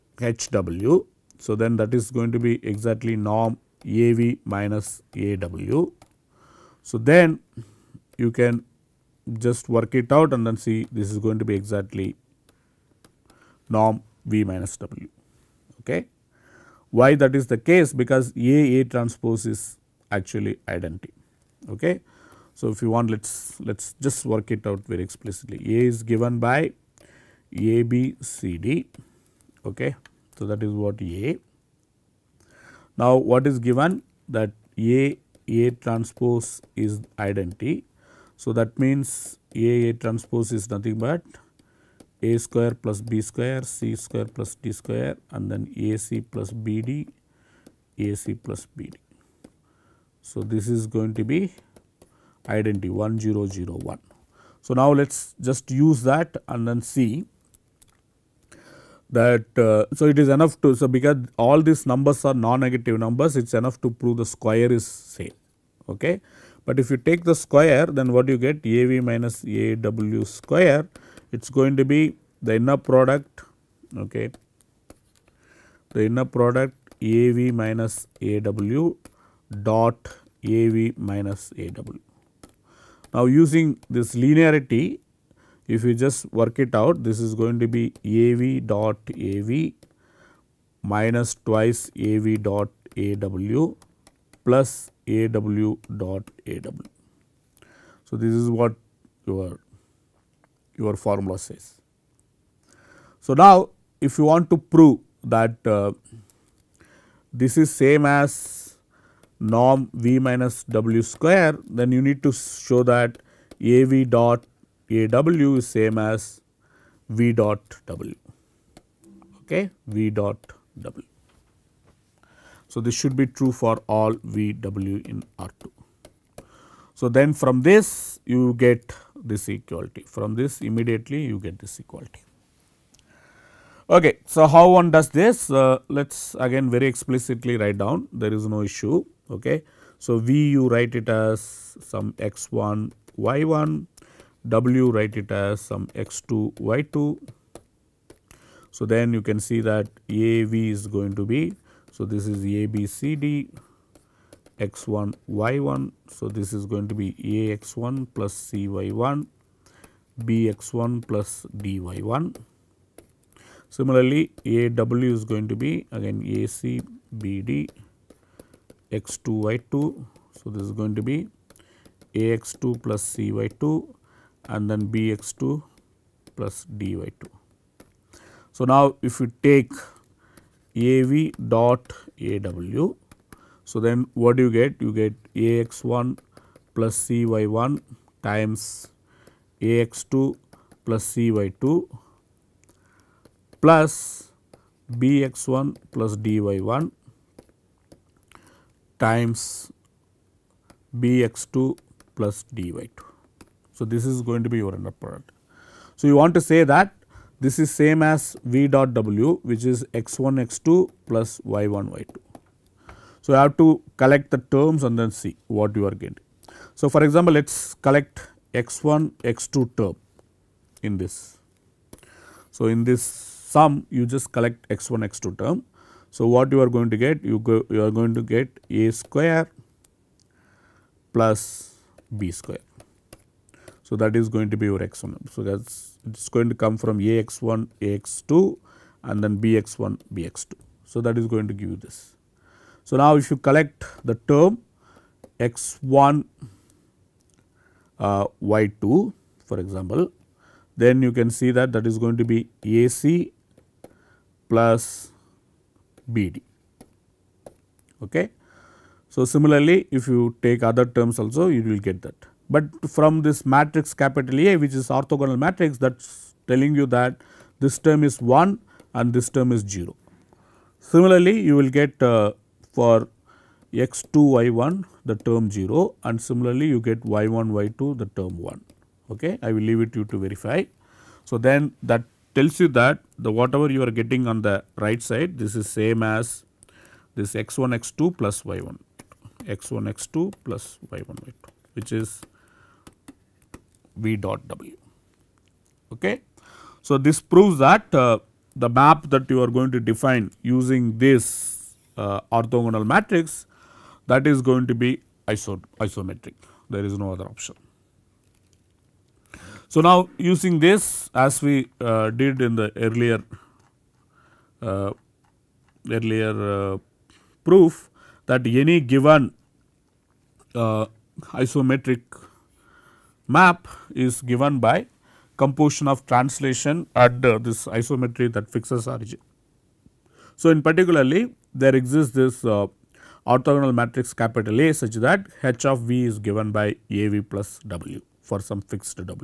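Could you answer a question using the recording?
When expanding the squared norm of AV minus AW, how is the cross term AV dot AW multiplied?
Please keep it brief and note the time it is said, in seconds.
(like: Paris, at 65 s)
twice, at 91 s.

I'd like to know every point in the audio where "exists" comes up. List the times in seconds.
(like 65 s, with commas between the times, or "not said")
331 s.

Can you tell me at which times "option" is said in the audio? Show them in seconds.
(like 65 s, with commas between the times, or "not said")
307 s.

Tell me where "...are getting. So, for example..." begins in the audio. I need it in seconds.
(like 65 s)
215 s.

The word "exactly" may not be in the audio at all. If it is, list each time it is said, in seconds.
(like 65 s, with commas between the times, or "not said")
2 s, 11 s.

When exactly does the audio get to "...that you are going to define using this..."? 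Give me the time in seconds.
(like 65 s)
299 s.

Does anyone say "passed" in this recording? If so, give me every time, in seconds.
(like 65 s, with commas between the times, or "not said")
not said.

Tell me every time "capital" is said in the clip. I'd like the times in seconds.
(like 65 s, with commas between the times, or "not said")
263 s, 334 s.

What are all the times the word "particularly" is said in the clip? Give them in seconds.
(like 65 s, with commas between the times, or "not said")
330 s.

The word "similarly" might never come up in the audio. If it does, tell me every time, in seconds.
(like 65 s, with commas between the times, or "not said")
163 s, 259 s, 270 s, 276 s.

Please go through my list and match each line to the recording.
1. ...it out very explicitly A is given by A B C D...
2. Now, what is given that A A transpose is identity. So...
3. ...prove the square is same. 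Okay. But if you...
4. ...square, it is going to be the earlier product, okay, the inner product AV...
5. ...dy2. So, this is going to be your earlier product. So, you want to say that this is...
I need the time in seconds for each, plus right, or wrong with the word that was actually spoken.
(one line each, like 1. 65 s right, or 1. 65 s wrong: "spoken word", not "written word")
1. 24 s right
2. 32 s right
3. 63 s right
4. 70 s wrong: "inner", not "earlier"
5. 202 s wrong: "inner", not "earlier".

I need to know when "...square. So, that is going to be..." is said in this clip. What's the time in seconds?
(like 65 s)
232 s.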